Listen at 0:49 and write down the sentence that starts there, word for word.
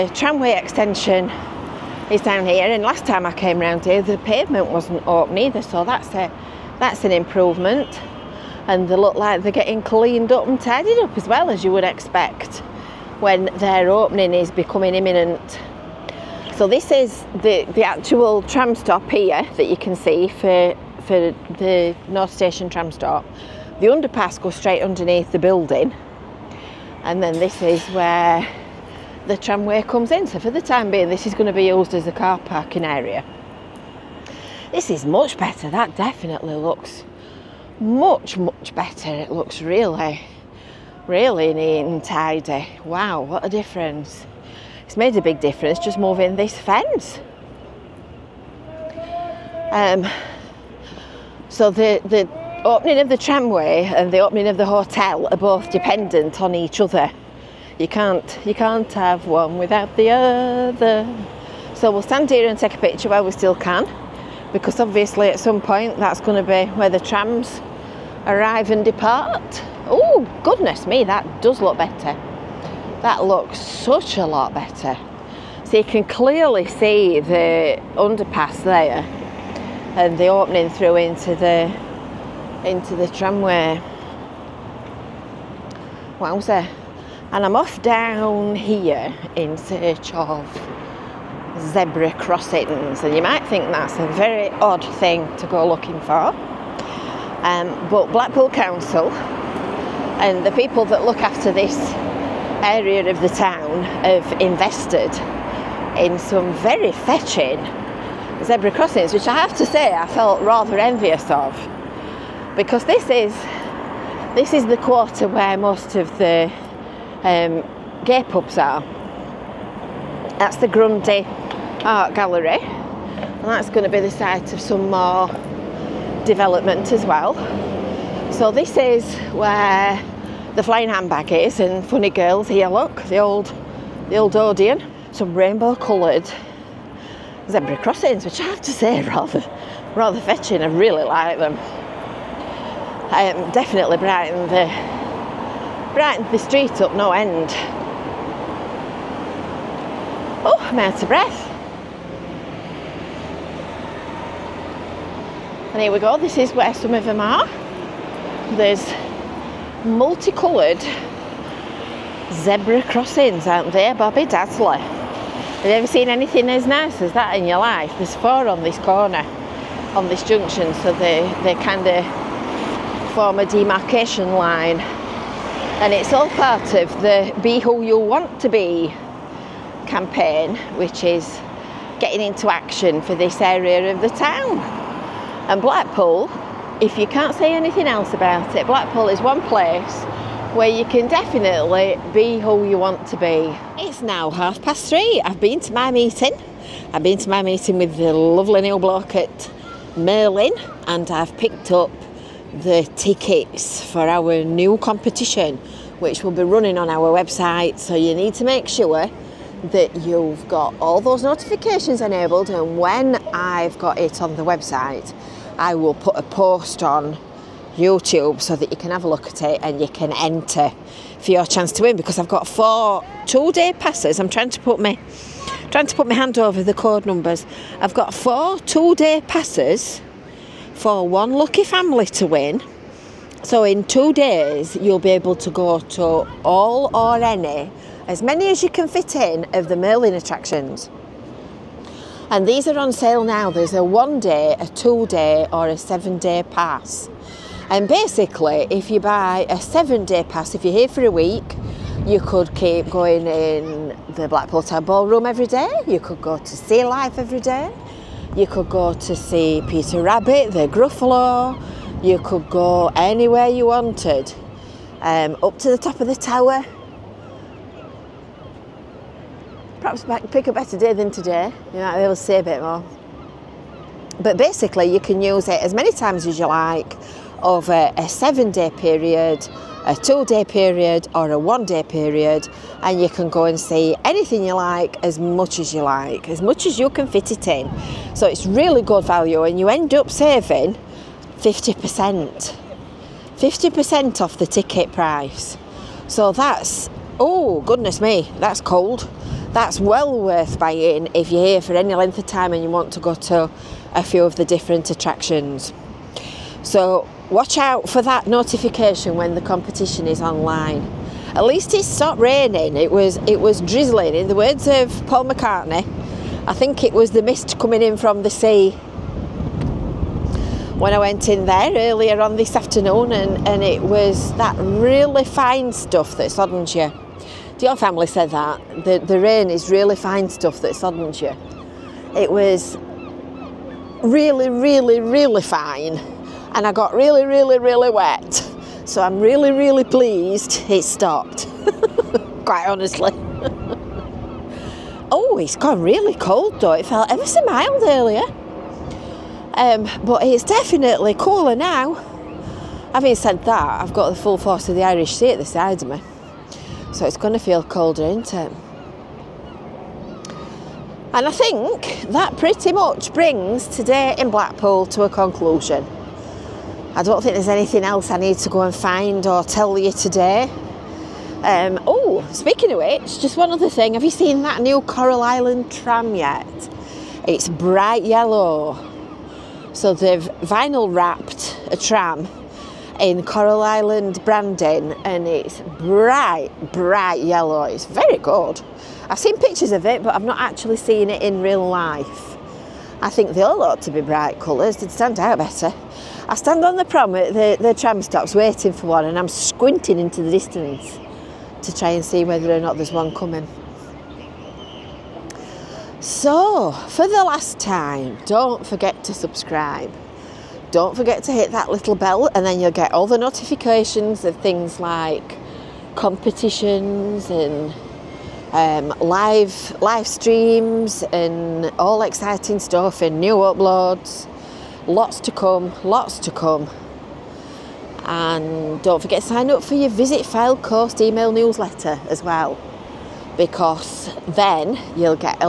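Um, so the, the opening of the tramway and the opening of the hotel are both dependent on each other.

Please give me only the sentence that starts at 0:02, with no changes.
And last time I came round here, the pavement wasn't open either, so that's it.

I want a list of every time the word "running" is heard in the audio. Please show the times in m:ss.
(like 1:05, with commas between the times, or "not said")
3:26.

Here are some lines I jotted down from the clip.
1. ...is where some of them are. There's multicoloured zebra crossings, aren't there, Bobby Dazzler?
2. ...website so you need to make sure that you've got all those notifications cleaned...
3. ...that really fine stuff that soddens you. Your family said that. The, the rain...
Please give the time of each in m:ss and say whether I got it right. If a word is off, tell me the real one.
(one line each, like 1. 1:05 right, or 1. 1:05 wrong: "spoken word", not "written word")
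1. 2:36 right
2. 3:27 wrong: "enabled", not "cleaned"
3. 5:24 right.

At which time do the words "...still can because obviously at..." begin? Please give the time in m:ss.
1:03.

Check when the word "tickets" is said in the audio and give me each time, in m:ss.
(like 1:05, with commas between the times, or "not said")
3:22, 4:54.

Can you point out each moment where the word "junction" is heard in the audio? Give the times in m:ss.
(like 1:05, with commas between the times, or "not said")
2:50.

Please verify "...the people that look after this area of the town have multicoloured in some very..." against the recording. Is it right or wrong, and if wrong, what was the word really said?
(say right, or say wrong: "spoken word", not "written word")
wrong: "invested", not "multicoloured".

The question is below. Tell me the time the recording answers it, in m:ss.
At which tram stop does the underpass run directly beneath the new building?
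0:22.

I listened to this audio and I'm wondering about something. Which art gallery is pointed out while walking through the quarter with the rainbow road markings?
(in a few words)
Grundy art gallery.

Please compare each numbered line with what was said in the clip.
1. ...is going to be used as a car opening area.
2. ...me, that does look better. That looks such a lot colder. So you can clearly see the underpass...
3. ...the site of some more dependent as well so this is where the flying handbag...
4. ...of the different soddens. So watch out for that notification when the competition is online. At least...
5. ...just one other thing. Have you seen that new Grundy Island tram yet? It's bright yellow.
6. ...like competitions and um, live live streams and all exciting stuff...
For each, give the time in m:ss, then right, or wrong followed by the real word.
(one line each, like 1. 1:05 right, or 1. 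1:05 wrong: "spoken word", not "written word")
1. 0:31 wrong: "parking", not "opening"
2. 1:10 wrong: "better", not "colder"
3. 2:04 wrong: "development", not "dependent"
4. 5:04 wrong: "attractions", not "soddens"
5. 6:13 wrong: "Coral", not "Grundy"
6. 6:54 right.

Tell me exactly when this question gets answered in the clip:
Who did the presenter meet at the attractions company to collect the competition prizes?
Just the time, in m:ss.
3:18.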